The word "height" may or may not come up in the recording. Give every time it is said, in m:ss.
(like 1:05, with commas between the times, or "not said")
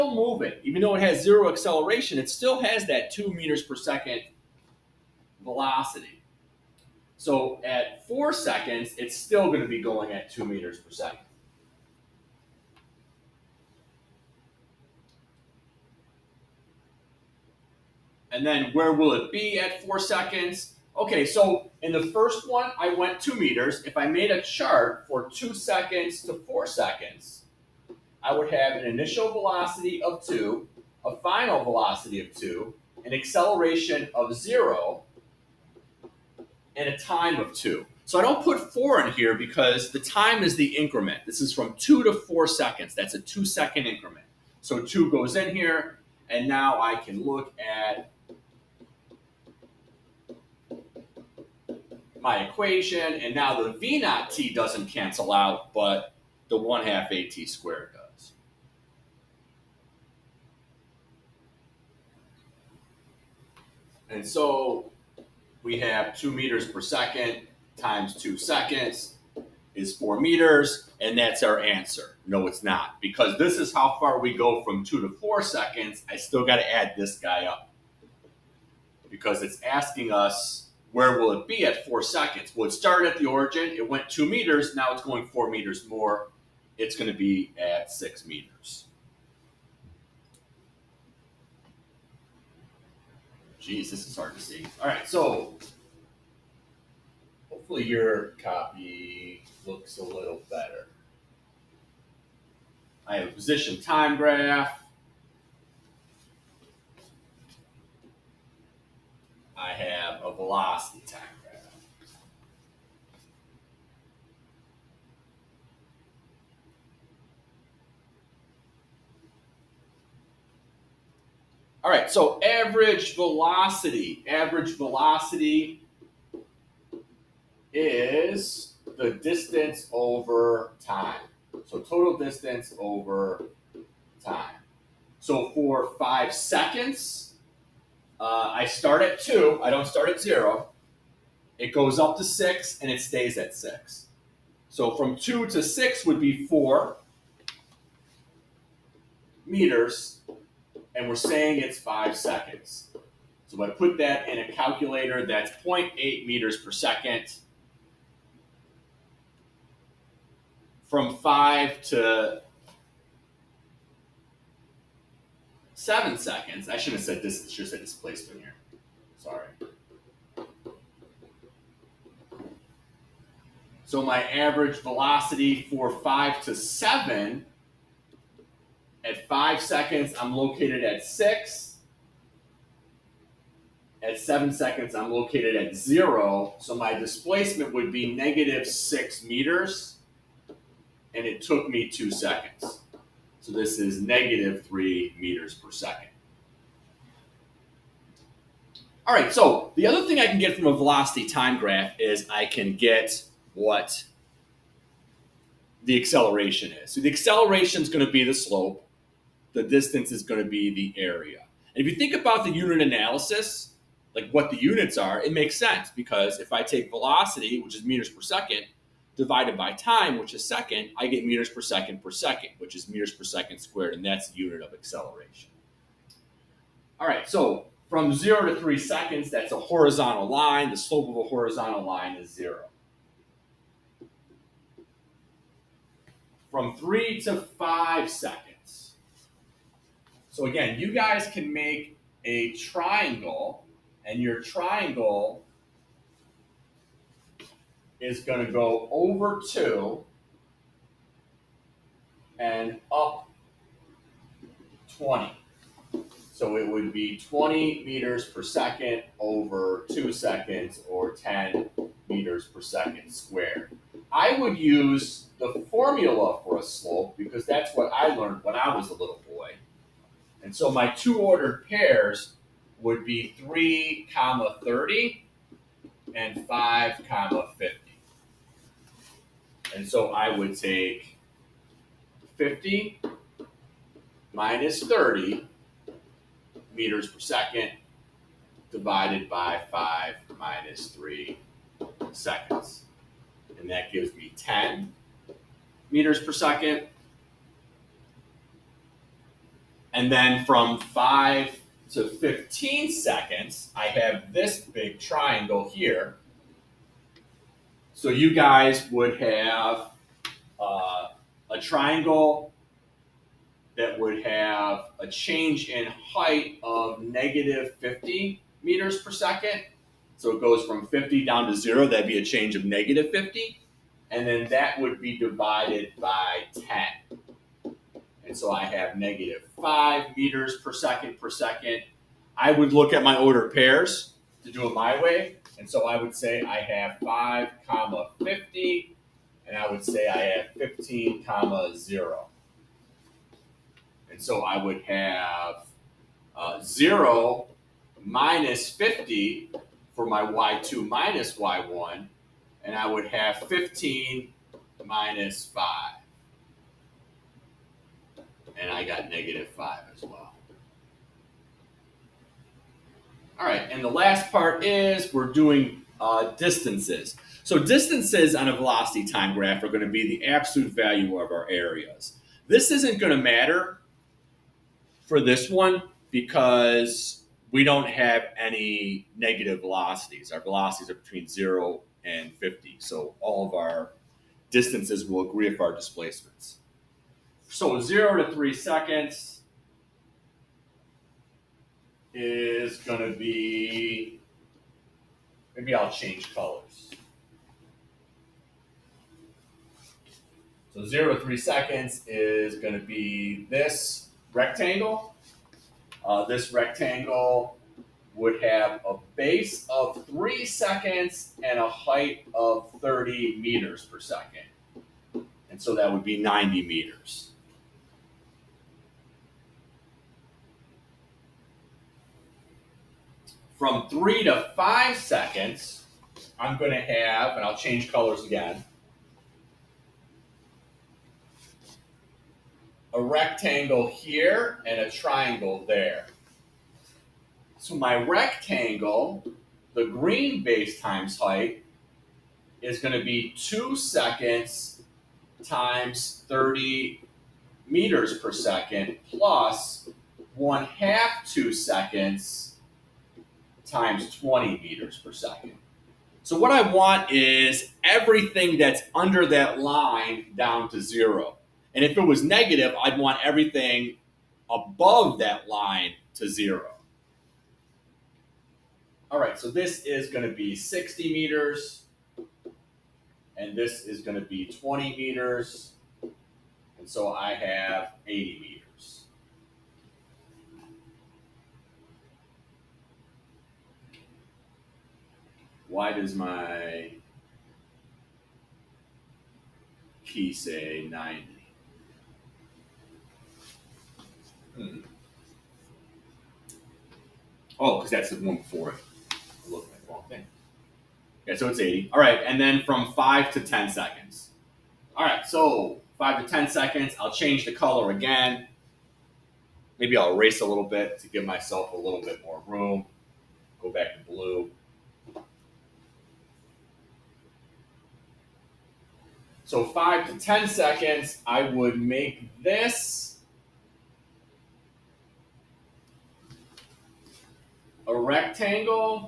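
5:15, 6:51, 7:21.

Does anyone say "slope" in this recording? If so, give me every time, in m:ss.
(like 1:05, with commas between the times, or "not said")
3:28, 3:50, 4:26.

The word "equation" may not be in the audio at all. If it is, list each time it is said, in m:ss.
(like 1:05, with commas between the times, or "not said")
0:52.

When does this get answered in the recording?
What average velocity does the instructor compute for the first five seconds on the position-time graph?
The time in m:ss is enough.
2:35.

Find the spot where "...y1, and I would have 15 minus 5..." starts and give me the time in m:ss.
5:51.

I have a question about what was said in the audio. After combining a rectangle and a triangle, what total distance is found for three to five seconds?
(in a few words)
80 meters.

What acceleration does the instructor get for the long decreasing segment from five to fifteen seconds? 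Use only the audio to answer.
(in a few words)
-5 meters per second per second.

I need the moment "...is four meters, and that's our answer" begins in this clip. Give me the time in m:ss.
1:09.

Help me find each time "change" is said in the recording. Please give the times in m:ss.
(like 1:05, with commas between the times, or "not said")
5:15, 5:22, 6:35, 7:07, 8:27.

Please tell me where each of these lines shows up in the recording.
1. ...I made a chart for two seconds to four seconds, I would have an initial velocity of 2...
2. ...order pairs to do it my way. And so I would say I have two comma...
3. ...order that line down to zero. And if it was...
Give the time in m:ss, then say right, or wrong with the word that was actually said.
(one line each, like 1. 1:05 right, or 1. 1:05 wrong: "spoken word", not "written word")
1. 0:23 right
2. 5:33 wrong: "five", not "two"
3. 7:38 wrong: "under", not "order".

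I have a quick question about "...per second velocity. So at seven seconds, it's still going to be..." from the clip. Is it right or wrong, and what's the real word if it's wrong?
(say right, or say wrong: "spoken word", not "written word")
wrong: "four", not "seven".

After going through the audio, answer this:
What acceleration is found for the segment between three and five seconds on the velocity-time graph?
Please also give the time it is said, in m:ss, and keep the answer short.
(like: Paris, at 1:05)
10 meters per second squared, at 4:21.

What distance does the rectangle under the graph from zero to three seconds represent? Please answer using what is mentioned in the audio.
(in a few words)
90 meters.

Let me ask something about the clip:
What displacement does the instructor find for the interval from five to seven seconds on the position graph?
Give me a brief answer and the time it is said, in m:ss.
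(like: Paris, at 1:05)
-6 meters, at 3:08.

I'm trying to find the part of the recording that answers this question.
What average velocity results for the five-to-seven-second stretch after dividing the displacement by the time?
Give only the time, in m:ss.
3:14.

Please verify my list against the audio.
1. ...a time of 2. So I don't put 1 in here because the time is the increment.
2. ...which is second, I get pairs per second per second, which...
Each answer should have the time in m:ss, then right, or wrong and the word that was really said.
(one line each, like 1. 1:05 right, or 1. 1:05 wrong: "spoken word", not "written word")
1. 0:36 wrong: "4", not "1"
2. 3:40 wrong: "meters", not "pairs".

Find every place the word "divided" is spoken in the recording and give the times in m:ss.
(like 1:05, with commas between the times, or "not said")
3:39, 4:48, 5:25.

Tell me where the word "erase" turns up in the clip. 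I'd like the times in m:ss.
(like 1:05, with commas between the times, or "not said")
8:30.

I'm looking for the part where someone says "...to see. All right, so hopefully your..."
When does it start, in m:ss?
1:34.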